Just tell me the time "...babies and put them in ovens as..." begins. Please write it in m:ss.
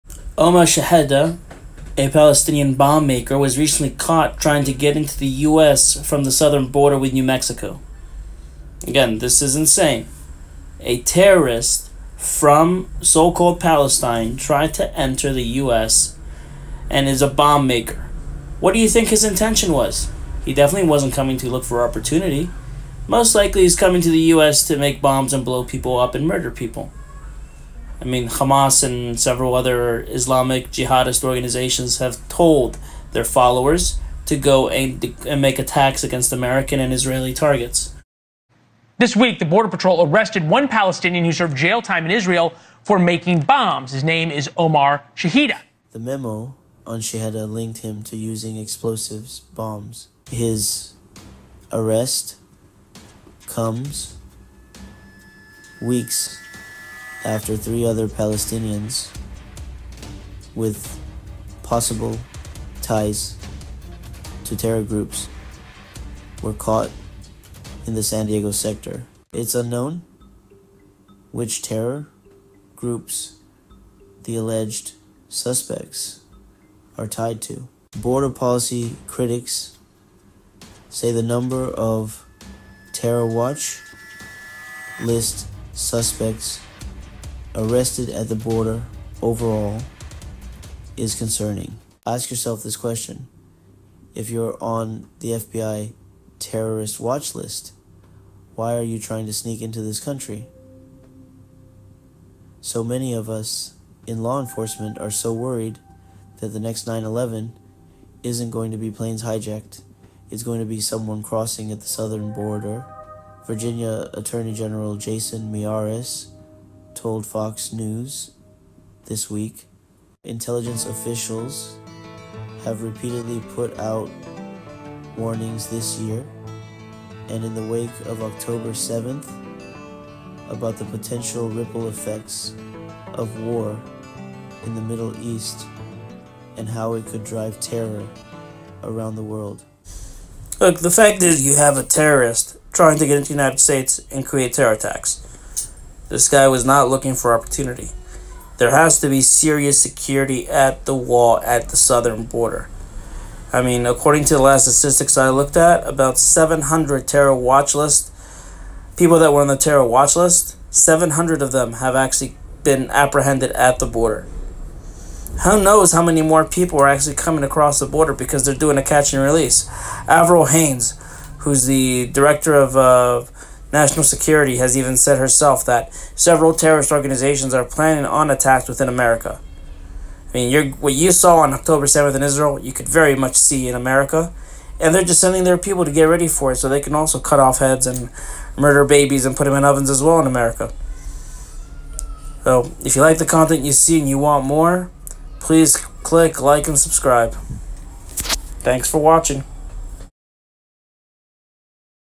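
3:08.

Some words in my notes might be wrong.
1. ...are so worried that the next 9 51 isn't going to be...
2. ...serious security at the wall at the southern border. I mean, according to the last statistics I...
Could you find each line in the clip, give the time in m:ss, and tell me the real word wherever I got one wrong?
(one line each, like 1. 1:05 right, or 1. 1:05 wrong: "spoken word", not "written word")
1. 1:44 wrong: "11", not "51"
2. 2:29 right.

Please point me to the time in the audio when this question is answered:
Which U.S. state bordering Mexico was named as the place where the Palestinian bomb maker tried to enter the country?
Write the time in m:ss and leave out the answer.
0:07.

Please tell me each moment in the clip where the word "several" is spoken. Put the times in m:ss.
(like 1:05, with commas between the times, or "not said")
0:29, 2:56.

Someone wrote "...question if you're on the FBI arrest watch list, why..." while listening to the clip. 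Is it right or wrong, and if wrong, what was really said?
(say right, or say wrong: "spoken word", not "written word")
wrong: "terrorist", not "arrest".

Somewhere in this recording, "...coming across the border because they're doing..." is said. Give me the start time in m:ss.
2:47.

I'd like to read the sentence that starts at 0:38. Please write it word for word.
This week, the Border Patrol arrested one Palestinian who served jail time in Israel for making bombs.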